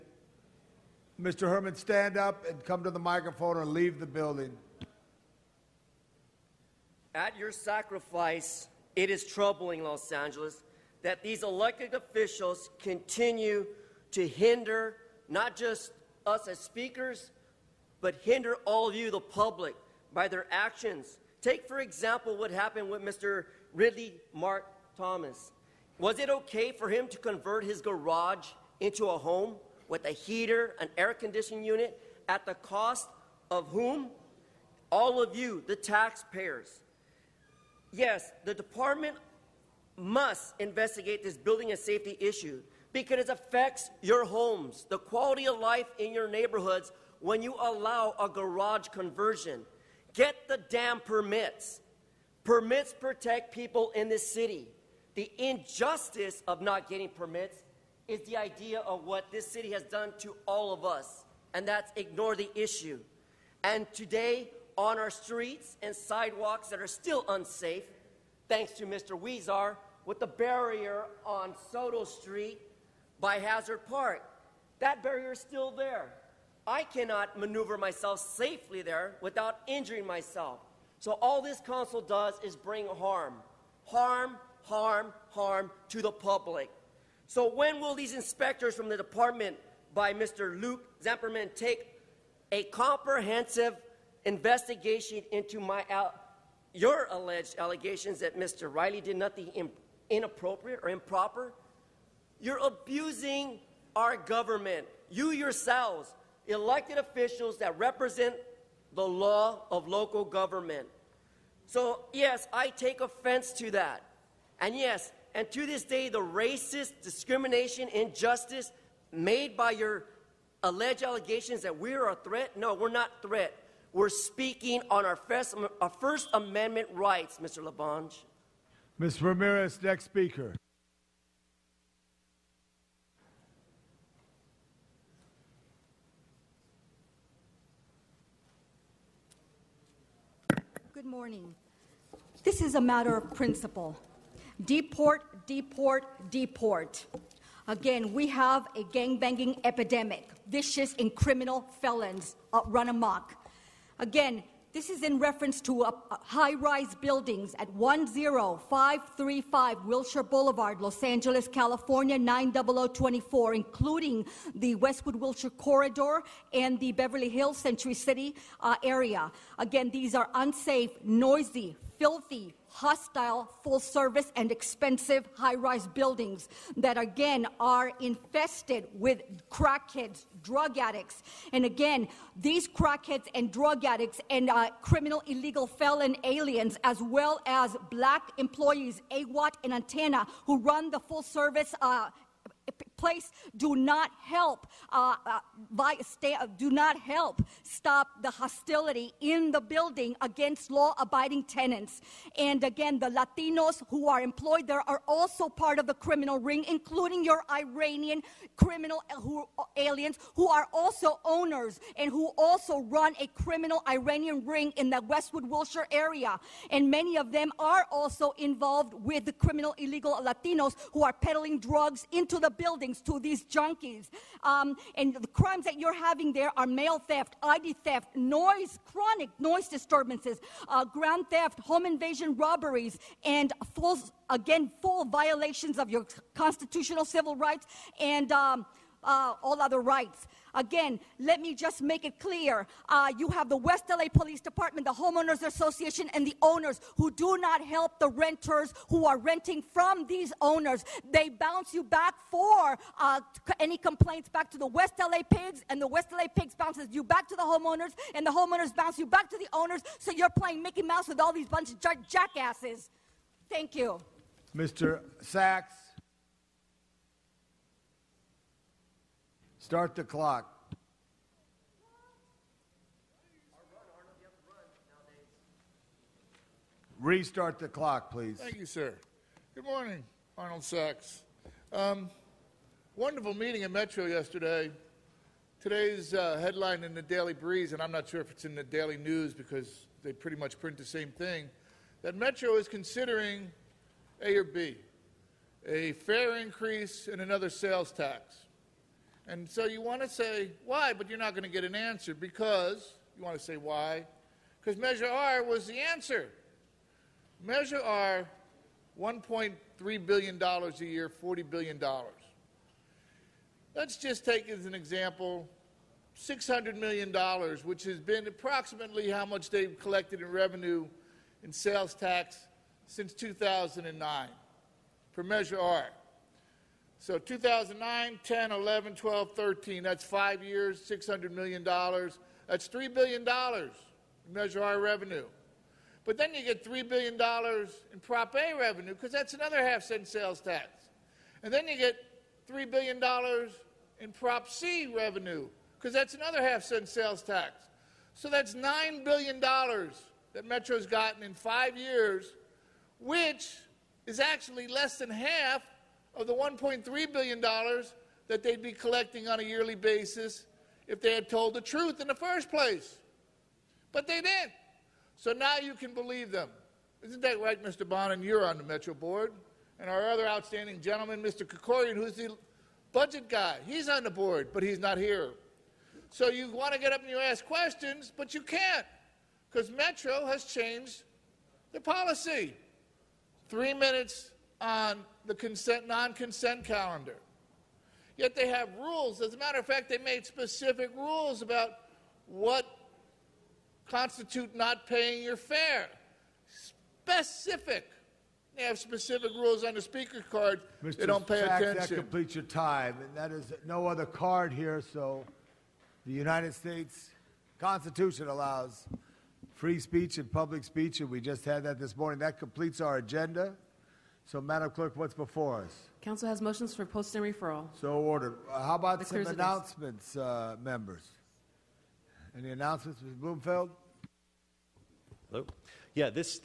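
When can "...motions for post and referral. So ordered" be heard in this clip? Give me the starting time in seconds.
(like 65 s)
416 s.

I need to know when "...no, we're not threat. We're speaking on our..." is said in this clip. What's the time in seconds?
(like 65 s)
122 s.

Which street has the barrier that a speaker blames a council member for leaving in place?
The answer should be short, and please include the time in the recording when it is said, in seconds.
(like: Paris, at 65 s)
Soto Street, at 71 s.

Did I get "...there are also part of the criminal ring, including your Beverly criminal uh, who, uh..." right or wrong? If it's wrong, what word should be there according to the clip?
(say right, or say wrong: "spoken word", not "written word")
wrong: "Iranian", not "Beverly".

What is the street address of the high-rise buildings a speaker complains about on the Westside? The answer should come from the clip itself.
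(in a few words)
10535 Wilshire Boulevard.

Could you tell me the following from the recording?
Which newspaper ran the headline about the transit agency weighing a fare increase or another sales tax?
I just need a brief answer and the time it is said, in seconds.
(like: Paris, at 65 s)
Daily Breeze, at 287 s.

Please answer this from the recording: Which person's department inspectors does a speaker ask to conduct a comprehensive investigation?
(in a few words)
Luke Zamperini.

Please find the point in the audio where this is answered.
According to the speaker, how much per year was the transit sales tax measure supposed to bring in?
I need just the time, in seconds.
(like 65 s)
308 s.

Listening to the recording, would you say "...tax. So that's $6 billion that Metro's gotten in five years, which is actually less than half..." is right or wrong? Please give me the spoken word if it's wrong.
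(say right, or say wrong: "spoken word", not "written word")
wrong: "9", not "6".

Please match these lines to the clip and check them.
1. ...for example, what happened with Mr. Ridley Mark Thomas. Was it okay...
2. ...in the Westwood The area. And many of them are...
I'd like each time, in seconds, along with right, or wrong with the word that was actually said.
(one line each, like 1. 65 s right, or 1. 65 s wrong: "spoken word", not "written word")
1. 21 s right
2. 214 s wrong: "Wilshire", not "The".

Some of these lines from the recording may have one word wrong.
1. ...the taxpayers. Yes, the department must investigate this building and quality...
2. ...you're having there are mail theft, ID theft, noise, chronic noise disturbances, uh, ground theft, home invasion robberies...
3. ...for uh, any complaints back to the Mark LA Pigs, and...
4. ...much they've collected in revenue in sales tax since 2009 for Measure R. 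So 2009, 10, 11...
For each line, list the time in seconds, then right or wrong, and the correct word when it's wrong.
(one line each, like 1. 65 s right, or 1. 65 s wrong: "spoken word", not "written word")
1. 35 s wrong: "safety", not "quality"
2. 225 s right
3. 252 s wrong: "West", not "Mark"
4. 319 s right.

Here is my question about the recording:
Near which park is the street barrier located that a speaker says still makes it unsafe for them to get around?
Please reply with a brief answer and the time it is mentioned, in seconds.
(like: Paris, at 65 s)
Hazard Park, at 73 s.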